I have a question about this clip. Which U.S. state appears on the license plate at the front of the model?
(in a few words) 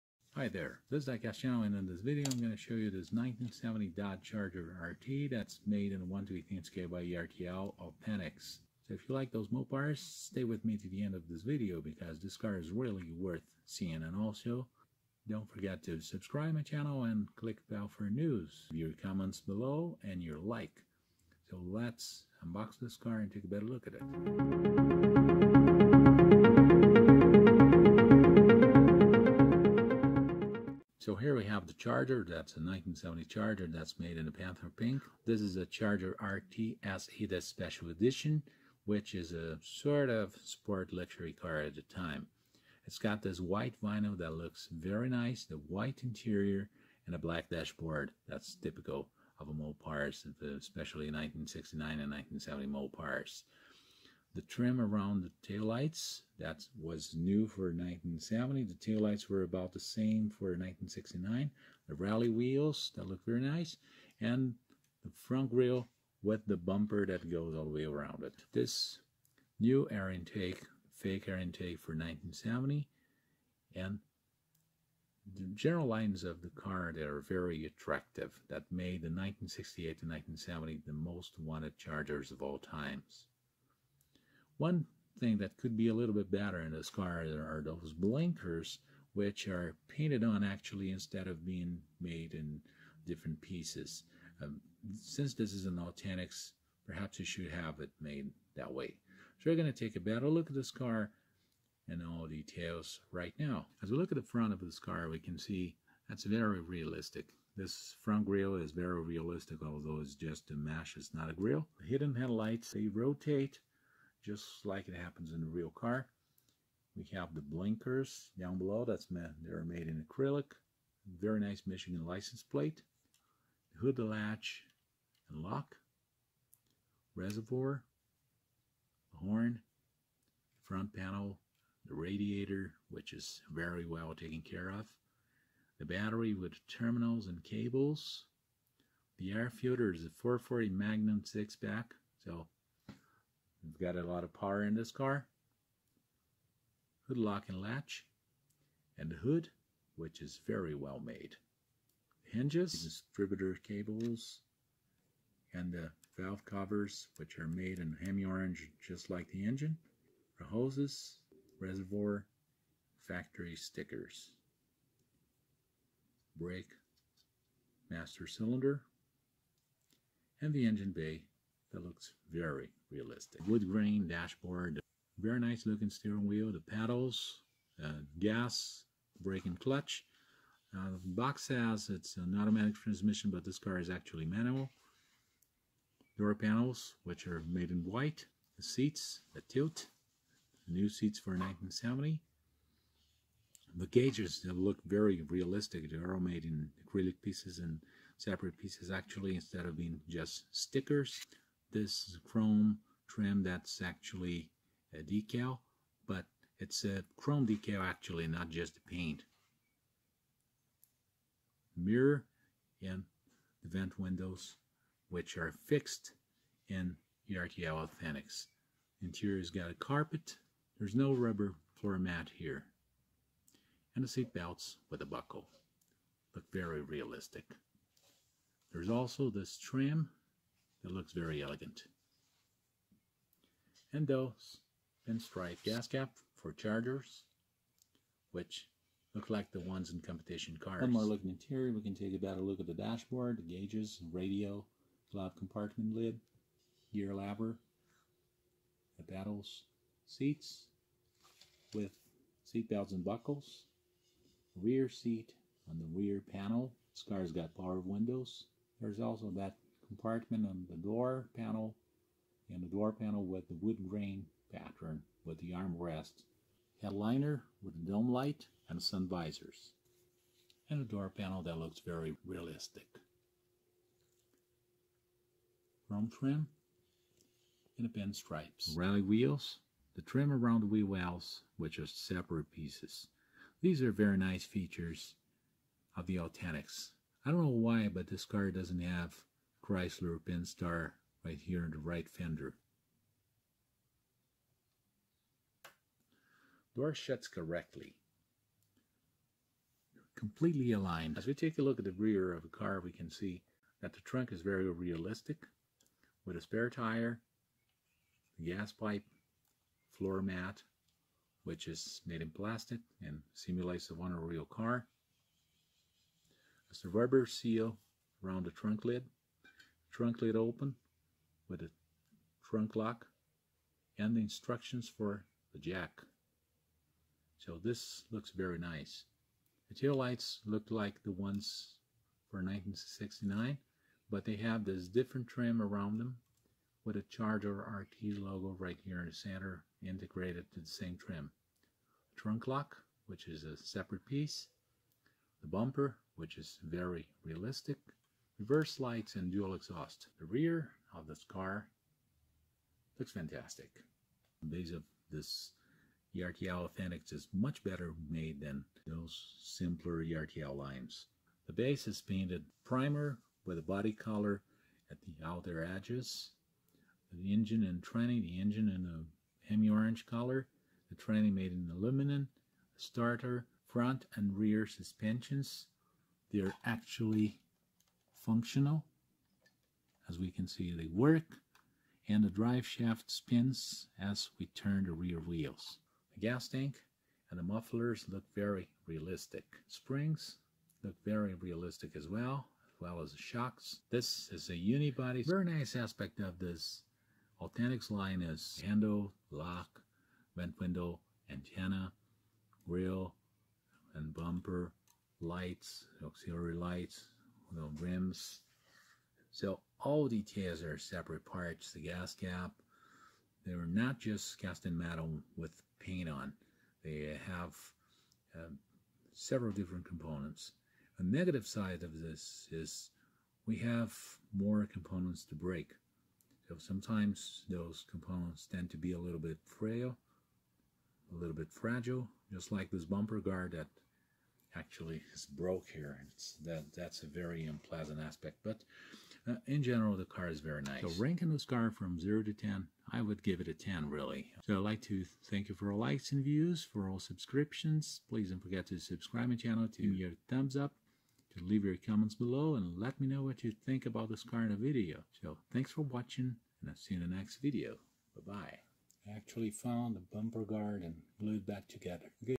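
Michigan.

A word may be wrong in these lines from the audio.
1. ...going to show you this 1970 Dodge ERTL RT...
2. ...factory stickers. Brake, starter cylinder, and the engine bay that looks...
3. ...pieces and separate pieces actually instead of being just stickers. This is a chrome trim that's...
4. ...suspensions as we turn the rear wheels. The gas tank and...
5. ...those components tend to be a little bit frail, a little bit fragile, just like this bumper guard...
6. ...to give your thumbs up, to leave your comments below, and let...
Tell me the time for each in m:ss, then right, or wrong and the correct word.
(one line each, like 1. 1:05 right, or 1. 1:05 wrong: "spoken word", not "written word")
1. 0:02 wrong: "Charger", not "ERTL"
2. 2:43 wrong: "master", not "starter"
3. 3:17 right
4. 6:23 wrong: "spins", not "suspensions"
5. 7:07 right
6. 7:29 right.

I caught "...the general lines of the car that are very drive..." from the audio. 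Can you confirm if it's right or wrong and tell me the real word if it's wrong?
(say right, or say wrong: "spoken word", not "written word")
wrong: "attractive", not "drive".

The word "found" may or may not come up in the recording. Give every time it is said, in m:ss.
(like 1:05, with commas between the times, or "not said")
7:39.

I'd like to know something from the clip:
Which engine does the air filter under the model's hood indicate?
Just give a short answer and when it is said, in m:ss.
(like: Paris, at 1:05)
440 Magnum six pack, at 2:20.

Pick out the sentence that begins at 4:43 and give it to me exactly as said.
These are very nice features of the Authentics.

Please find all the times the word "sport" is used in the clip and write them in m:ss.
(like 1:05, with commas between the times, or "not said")
0:40.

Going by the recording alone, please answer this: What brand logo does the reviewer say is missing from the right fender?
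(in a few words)
Chrysler Pentastar.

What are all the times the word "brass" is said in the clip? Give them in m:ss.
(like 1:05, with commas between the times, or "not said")
not said.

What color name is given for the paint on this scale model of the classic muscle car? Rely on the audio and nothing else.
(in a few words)
Panther Pink.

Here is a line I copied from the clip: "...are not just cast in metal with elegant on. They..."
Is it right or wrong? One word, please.
wrong.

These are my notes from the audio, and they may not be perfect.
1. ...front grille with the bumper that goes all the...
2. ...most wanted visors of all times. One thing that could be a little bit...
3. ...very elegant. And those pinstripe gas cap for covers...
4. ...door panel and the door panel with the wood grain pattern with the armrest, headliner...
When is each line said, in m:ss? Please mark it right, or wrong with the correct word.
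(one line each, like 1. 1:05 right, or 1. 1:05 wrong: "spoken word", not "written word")
1. 1:05 right
2. 1:20 wrong: "chargers", not "visors"
3. 3:51 wrong: "chargers", not "covers"
4. 4:20 right.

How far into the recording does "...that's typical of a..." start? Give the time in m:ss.
0:48.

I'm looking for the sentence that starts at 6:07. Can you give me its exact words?
The engine and tranny, the engine in a hemi-orange color, the tranny made in aluminum, starter, front and rear suspensions.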